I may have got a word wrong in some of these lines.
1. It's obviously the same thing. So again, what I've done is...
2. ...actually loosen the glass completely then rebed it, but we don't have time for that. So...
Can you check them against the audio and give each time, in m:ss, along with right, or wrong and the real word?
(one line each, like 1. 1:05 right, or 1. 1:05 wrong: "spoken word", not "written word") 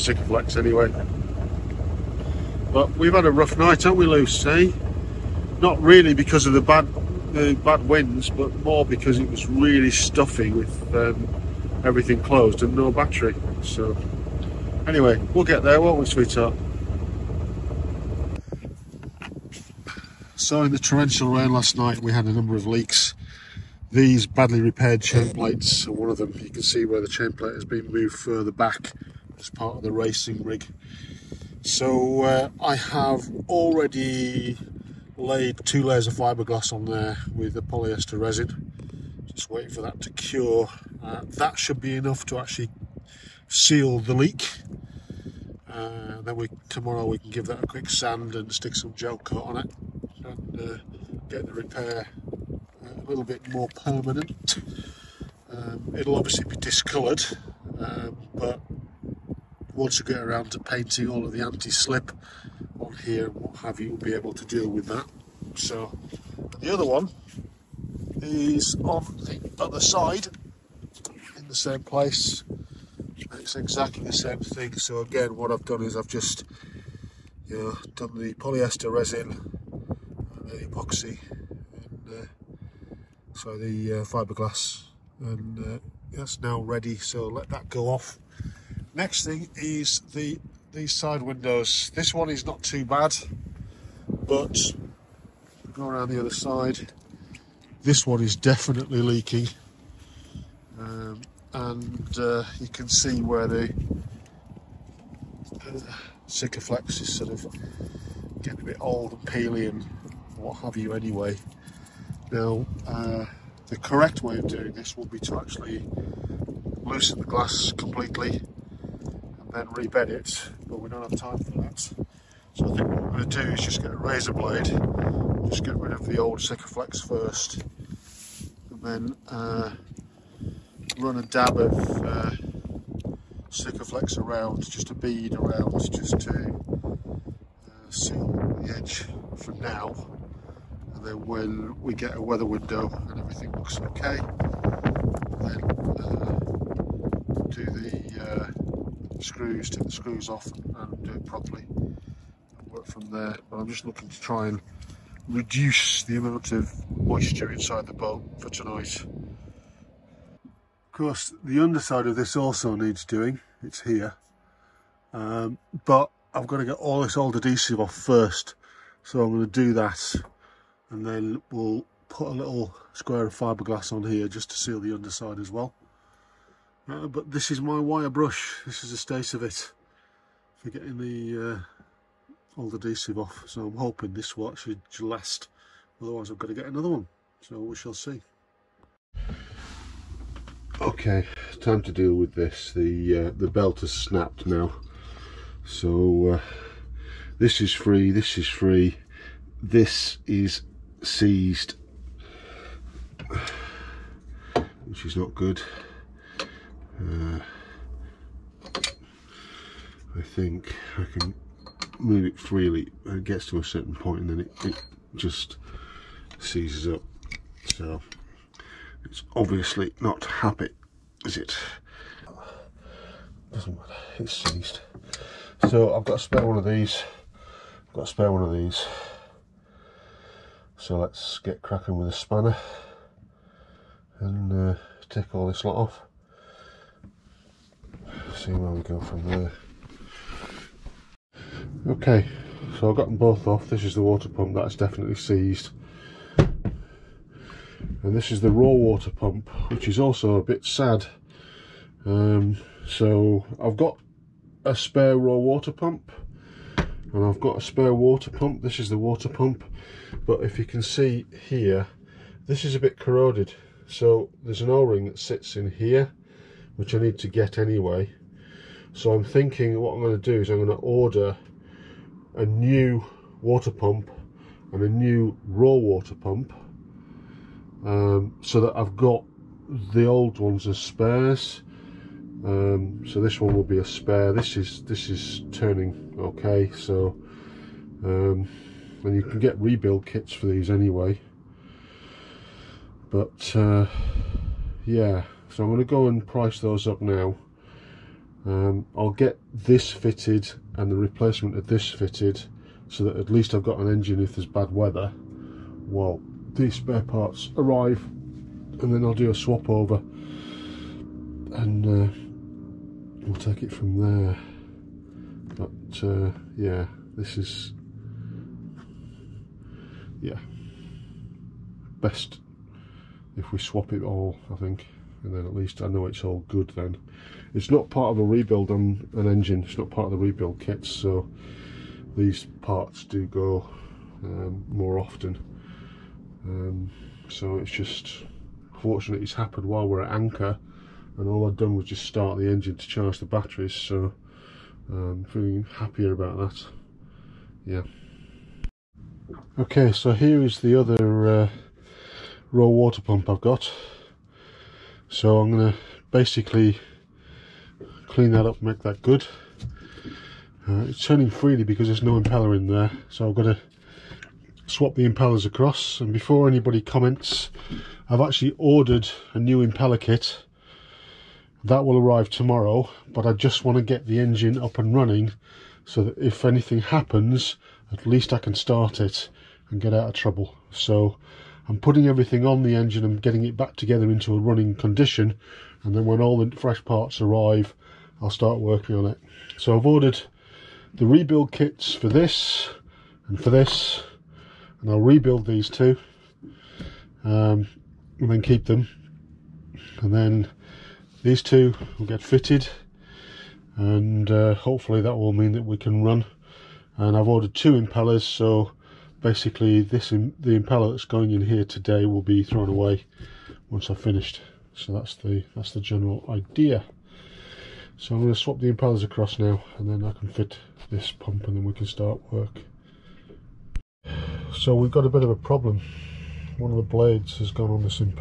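1. 1:13 wrong: "exactly", not "obviously"
2. 1:55 right.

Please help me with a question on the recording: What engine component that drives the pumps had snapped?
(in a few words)
the belt.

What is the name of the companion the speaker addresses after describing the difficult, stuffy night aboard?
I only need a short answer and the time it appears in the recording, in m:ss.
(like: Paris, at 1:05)
Lucy, at 0:04.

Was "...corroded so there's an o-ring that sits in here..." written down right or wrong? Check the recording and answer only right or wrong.
right.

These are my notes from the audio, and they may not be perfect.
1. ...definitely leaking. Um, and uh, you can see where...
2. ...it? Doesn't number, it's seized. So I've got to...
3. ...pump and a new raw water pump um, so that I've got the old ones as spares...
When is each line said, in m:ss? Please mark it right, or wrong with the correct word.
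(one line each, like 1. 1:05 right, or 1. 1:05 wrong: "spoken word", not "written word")
1. 1:38 right
2. 3:41 wrong: "matter", not "number"
3. 4:33 right.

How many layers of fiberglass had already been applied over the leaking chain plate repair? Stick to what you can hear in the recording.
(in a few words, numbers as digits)
2.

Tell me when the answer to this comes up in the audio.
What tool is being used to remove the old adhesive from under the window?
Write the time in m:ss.
2:57.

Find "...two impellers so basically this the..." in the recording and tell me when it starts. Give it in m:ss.
6:47.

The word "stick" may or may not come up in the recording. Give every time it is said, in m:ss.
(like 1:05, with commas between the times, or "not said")
0:48.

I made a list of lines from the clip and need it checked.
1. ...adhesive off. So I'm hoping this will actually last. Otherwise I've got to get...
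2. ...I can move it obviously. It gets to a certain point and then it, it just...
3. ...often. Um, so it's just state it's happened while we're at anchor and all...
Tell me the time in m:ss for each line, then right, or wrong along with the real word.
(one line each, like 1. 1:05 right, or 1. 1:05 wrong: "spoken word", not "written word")
1. 3:02 right
2. 3:30 wrong: "freely", not "obviously"
3. 5:34 wrong: "fortunate", not "state".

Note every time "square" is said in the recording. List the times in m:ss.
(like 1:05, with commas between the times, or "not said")
2:52.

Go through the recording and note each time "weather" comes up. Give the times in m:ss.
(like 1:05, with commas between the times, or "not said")
2:22, 5:04.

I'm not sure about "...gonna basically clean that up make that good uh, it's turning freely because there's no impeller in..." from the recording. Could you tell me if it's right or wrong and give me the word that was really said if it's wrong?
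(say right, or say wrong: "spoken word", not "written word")
right.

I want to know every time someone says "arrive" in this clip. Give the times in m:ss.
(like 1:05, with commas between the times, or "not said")
5:07, 6:11, 6:27.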